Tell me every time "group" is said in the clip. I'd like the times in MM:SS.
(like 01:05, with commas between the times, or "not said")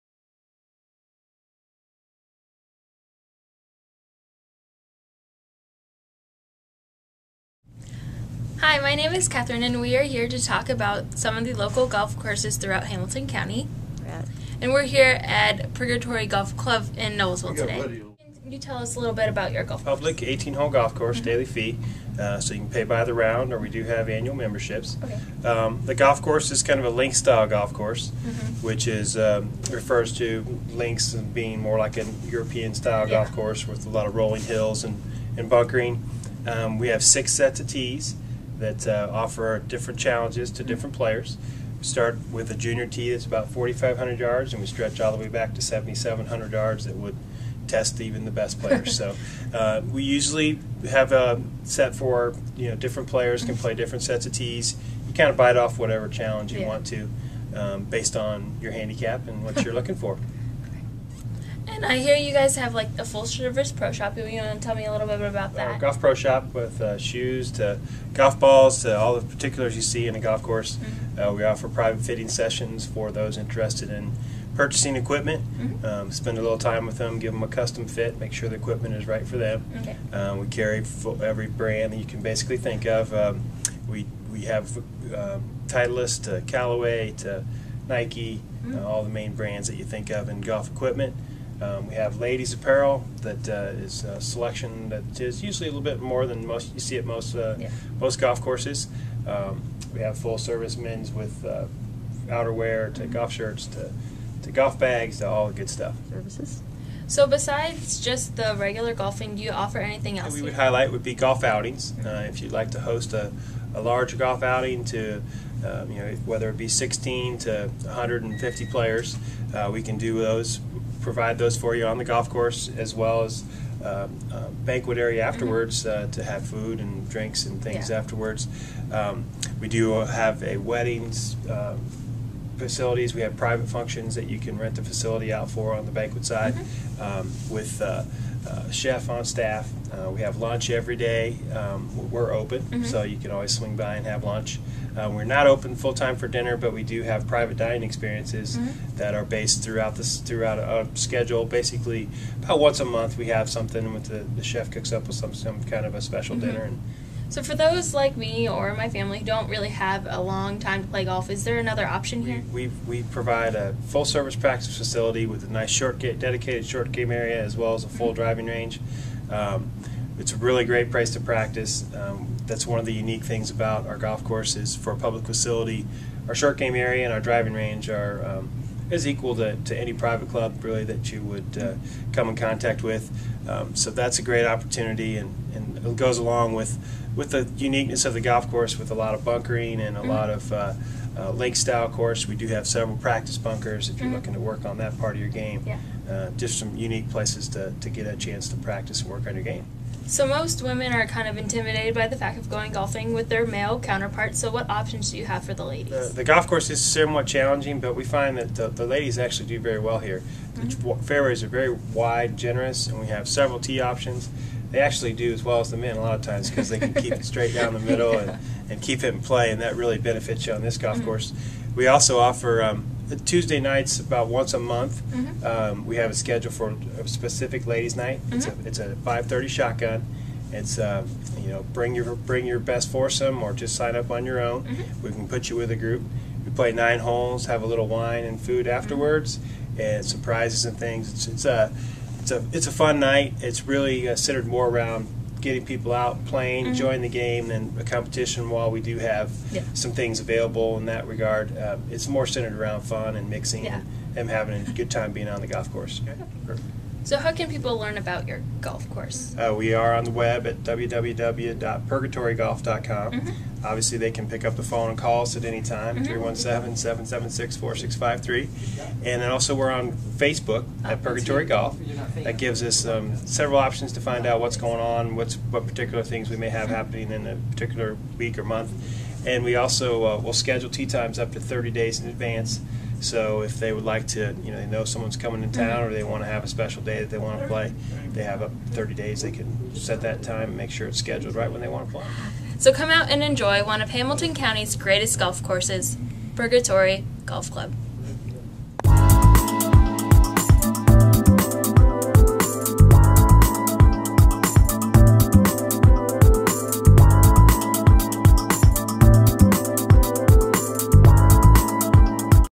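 03:55.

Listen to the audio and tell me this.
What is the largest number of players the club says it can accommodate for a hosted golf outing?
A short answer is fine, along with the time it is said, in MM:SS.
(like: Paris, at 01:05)
150, at 01:57.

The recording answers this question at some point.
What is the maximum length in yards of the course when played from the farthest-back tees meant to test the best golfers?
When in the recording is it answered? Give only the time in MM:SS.
00:45.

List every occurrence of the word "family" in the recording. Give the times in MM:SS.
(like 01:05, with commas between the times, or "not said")
02:38.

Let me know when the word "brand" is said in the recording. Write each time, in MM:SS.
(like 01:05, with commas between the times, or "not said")
01:21, 01:29.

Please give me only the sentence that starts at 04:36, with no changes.
happening in a particular week or month.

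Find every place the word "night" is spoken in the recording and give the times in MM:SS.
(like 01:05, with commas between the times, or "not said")
03:43, 03:47, 04:02.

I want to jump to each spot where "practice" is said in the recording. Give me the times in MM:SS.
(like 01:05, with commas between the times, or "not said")
02:44, 02:51, 03:12, 03:18.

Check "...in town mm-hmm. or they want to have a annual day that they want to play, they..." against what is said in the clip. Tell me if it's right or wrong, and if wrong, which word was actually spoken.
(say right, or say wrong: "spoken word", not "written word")
wrong: "special", not "annual".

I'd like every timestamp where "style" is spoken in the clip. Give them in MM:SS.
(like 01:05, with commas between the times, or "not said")
00:27, 00:32, 03:11.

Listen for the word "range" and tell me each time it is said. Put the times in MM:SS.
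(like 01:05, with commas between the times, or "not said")
02:48, 02:57.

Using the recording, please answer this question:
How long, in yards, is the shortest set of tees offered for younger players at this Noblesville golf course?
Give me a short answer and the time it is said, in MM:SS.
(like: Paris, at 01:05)
4,500 yards, at 00:43.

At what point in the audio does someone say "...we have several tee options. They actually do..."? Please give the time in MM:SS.
03:32.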